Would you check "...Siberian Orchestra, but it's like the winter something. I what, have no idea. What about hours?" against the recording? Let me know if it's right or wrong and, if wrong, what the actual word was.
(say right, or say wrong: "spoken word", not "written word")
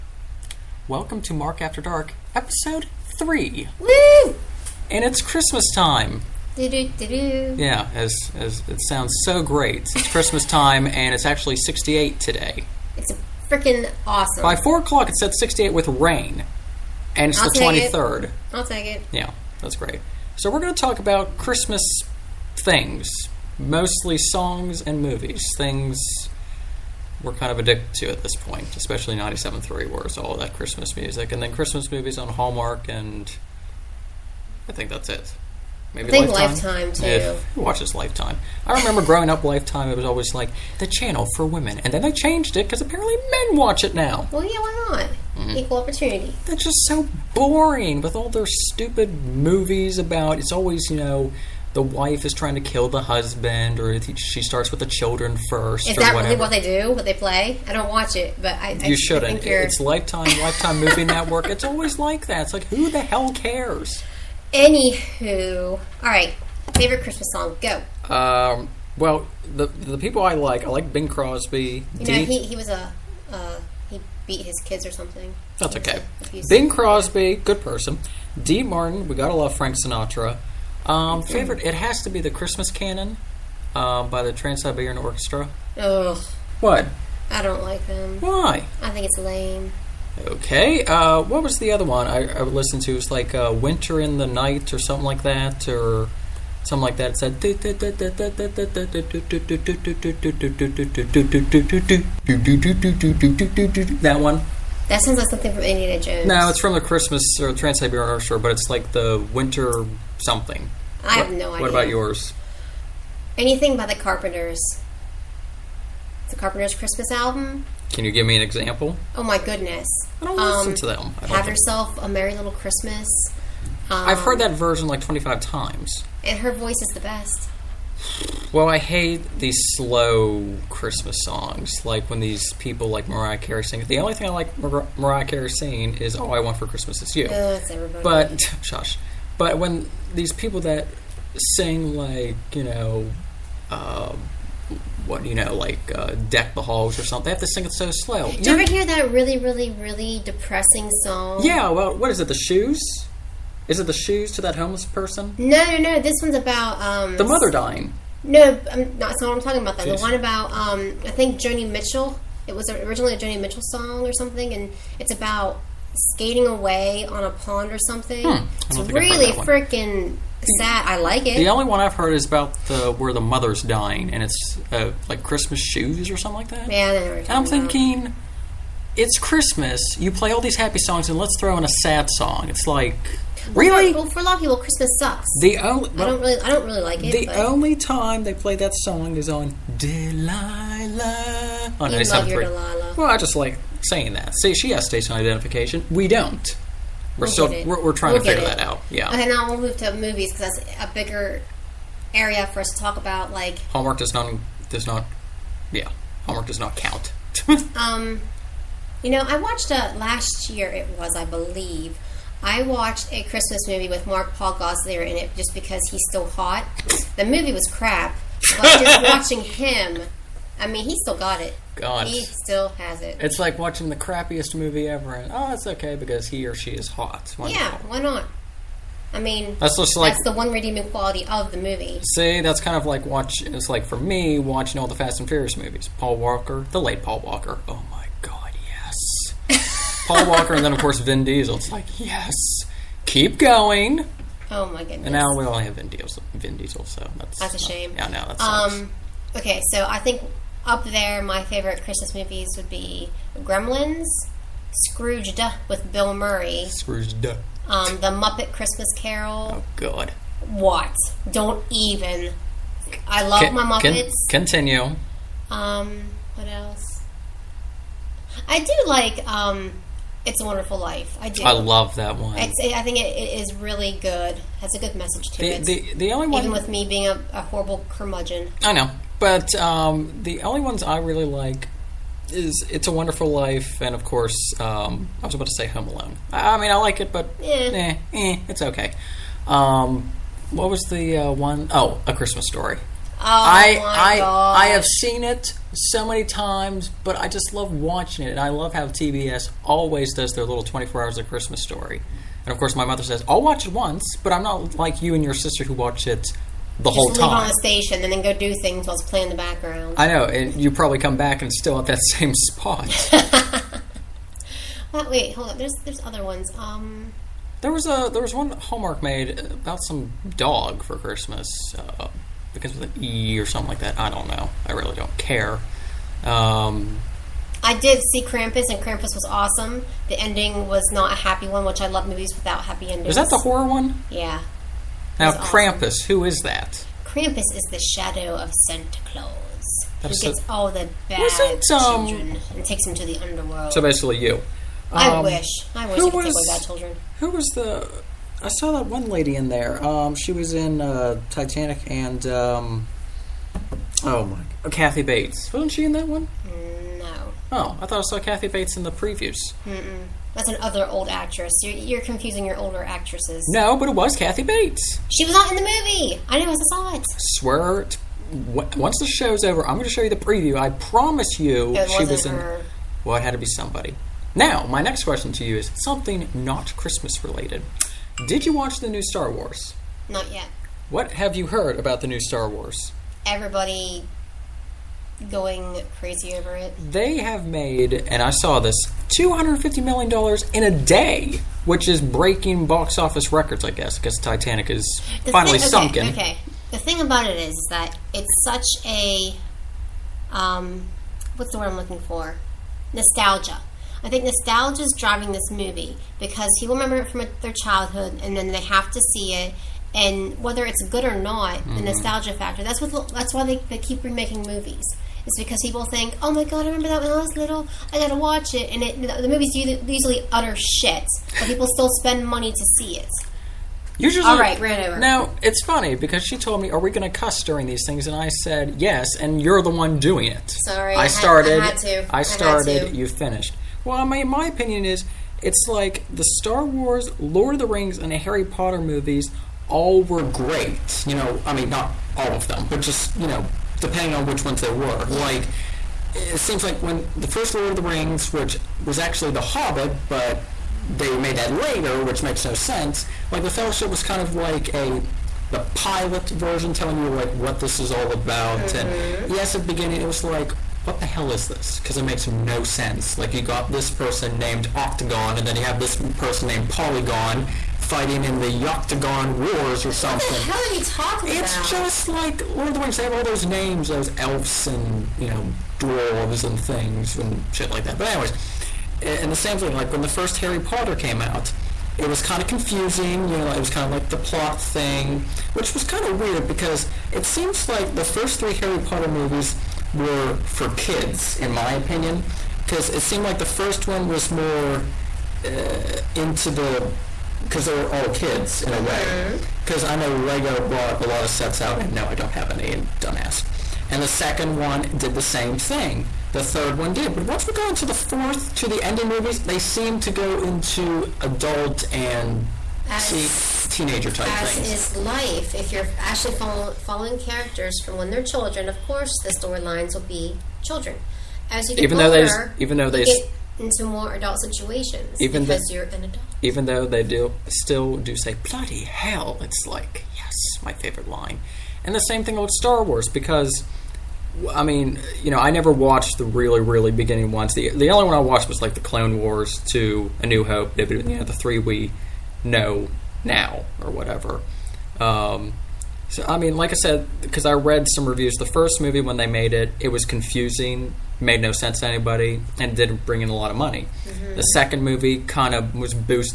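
wrong: "yours", not "hours".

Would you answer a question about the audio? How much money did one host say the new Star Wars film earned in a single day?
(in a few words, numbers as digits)
$250 million.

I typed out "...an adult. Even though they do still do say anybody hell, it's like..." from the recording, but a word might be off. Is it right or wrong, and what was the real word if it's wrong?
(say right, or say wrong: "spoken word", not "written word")
wrong: "bloody", not "anybody".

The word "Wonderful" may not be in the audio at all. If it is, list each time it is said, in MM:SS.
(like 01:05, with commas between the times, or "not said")
04:30, 04:42.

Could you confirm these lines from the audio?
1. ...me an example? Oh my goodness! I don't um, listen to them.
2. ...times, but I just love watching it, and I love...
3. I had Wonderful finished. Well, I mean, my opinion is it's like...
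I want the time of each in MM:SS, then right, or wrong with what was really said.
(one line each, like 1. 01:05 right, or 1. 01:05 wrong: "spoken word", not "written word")
1. 01:58 right
2. 04:56 right
3. 07:12 wrong: "You", not "Wonderful".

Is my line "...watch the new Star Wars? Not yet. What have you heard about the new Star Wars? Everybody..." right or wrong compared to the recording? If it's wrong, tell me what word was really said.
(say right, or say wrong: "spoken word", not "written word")
right.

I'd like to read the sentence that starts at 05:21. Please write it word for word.
Uh, begins with an E or something like that.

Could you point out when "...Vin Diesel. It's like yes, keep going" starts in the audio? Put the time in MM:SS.
04:00.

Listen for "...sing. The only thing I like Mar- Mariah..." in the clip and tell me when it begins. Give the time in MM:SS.
02:13.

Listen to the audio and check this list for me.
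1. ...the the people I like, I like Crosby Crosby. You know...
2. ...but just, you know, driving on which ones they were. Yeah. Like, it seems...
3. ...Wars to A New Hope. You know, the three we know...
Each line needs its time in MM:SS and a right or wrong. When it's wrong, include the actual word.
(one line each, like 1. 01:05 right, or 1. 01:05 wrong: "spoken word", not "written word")
1. 01:09 wrong: "Bing", not "Crosby"
2. 07:22 wrong: "depending", not "driving"
3. 08:59 right.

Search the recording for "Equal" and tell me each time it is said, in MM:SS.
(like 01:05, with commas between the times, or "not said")
00:45.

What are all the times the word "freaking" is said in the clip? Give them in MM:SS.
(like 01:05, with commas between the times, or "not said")
00:13, 02:49.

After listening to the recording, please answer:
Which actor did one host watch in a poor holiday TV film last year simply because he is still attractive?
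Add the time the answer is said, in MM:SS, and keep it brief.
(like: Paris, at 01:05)
Mark Paul Gosselaar, at 03:34.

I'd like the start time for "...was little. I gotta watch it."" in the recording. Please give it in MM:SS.
06:57.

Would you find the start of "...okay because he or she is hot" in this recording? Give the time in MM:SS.
03:45.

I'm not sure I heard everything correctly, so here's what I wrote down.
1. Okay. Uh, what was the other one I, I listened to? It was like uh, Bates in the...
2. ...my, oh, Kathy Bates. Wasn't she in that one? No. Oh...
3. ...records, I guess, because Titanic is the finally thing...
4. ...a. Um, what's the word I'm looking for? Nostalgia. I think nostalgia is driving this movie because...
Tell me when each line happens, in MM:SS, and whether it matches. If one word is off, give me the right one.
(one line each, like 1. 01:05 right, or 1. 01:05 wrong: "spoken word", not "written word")
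1. 01:30 wrong: "Winter", not "Bates"
2. 05:54 right
3. 06:33 right
4. 06:38 right.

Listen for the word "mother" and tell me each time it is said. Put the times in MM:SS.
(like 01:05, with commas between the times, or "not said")
02:37, 02:53, 05:02.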